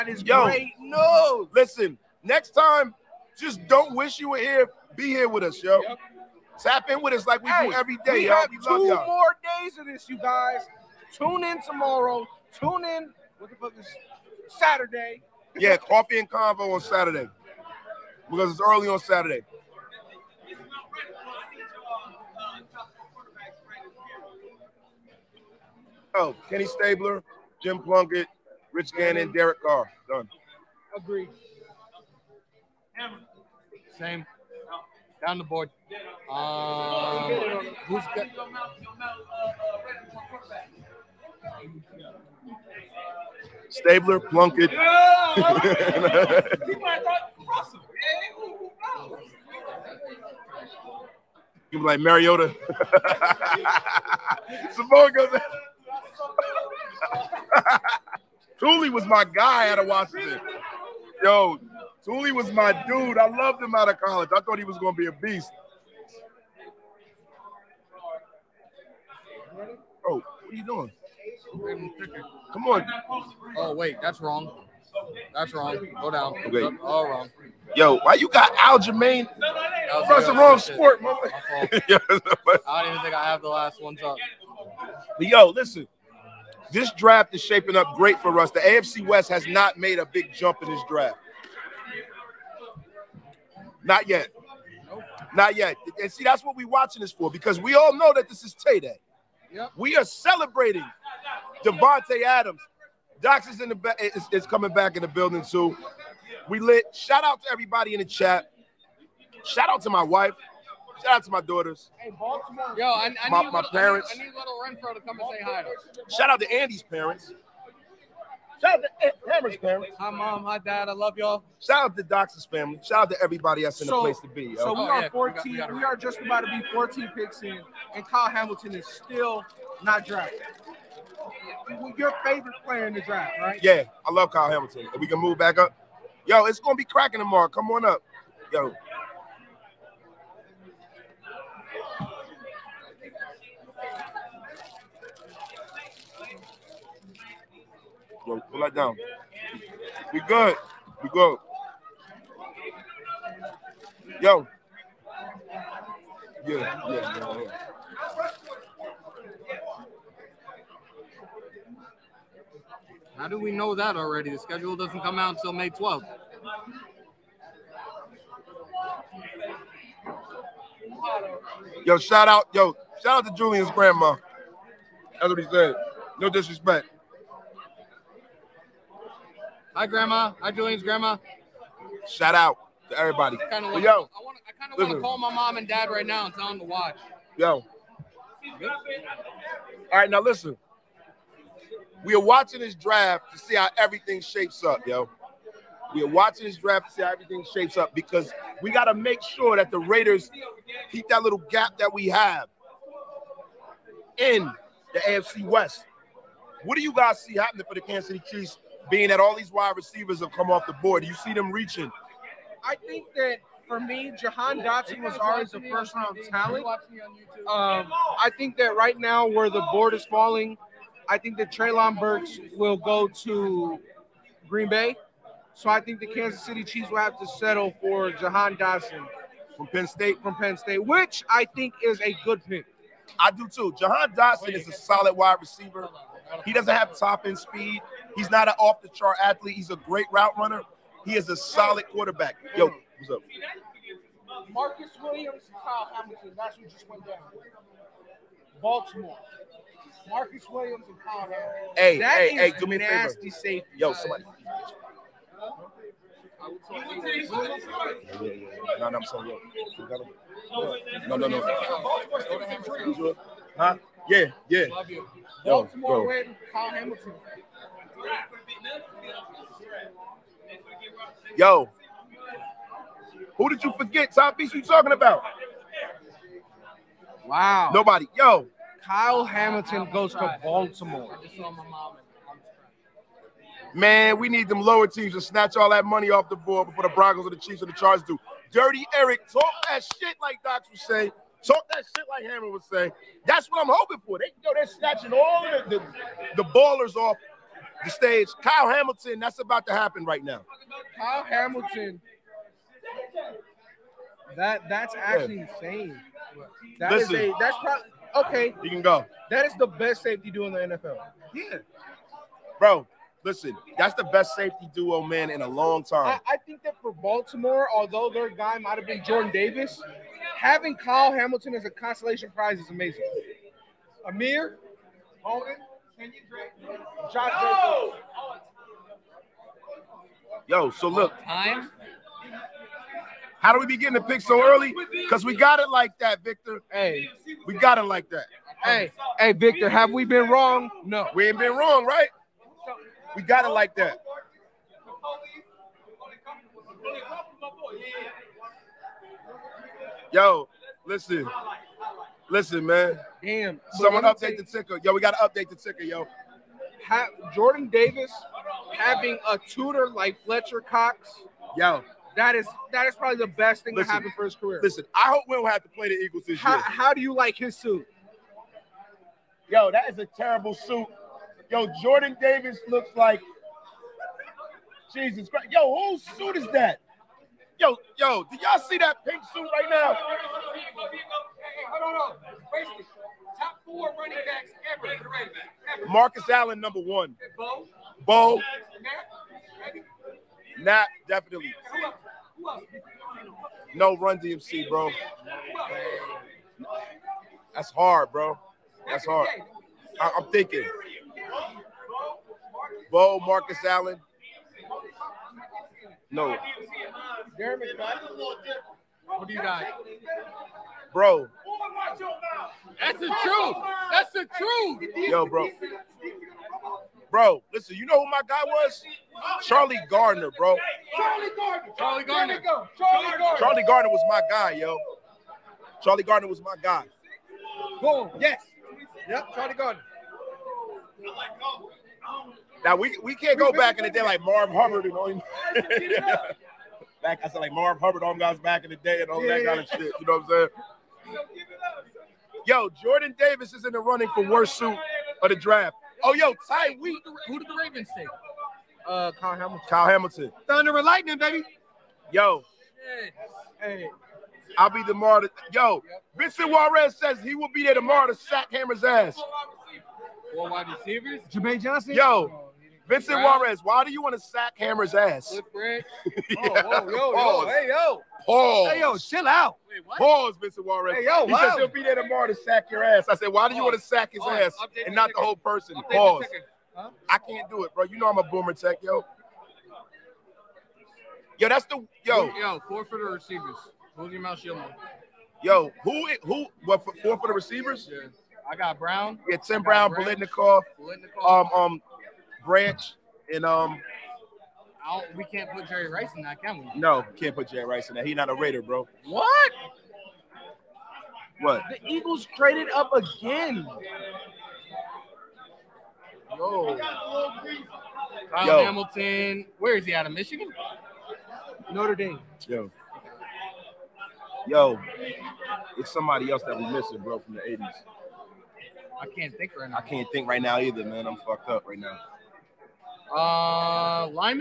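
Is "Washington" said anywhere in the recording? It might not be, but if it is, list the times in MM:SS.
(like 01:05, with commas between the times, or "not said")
00:59.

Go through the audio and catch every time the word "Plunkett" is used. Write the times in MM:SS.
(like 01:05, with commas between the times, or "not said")
00:27, 00:44.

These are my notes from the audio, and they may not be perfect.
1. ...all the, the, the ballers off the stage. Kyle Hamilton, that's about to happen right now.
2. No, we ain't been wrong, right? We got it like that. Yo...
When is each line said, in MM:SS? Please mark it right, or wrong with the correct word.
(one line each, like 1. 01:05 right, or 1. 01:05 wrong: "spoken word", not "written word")
1. 04:55 right
2. 05:40 right.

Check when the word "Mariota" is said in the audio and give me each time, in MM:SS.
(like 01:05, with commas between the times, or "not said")
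00:52.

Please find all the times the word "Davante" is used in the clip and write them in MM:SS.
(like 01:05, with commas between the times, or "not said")
01:41.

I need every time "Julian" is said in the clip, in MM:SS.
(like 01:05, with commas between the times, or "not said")
02:53, 03:00.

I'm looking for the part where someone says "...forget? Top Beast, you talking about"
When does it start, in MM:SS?
04:33.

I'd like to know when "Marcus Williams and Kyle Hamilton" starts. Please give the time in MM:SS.
04:10.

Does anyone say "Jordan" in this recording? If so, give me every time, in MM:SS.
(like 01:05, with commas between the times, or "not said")
05:19, 05:57, 06:11, 07:22.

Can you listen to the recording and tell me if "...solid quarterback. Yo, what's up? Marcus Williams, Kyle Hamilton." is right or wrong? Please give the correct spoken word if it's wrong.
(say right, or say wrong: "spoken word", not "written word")
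right.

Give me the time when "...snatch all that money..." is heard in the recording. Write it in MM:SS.
04:45.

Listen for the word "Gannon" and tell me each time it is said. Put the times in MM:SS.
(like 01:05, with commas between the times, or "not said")
00:28.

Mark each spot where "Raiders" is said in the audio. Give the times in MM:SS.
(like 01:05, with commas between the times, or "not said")
03:19, 08:18.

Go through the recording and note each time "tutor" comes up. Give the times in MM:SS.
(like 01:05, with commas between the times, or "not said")
05:59.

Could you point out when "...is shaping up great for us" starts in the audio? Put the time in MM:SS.
01:27.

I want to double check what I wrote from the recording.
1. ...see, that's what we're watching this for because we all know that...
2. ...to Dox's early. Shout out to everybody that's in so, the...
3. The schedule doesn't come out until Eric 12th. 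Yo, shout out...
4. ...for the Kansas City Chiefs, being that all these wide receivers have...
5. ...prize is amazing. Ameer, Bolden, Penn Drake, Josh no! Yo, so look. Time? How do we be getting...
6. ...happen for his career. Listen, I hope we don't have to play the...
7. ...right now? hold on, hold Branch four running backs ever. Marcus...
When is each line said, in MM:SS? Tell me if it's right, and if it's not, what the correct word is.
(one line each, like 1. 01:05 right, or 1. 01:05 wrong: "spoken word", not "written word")
1. 01:36 right
2. 02:01 wrong: "family", not "early"
3. 02:44 wrong: "May", not "Eric"
4. 03:27 right
5. 05:22 wrong: "Kenyan", not "Penn"
6. 06:03 right
7. 06:19 wrong: "Top", not "Branch".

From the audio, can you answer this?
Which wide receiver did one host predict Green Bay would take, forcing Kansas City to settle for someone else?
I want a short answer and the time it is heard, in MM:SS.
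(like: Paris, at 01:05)
Treylon Burks, at 03:41.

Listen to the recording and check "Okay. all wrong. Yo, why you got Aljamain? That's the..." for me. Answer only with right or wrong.
right.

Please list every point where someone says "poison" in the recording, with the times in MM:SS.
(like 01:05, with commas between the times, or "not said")
not said.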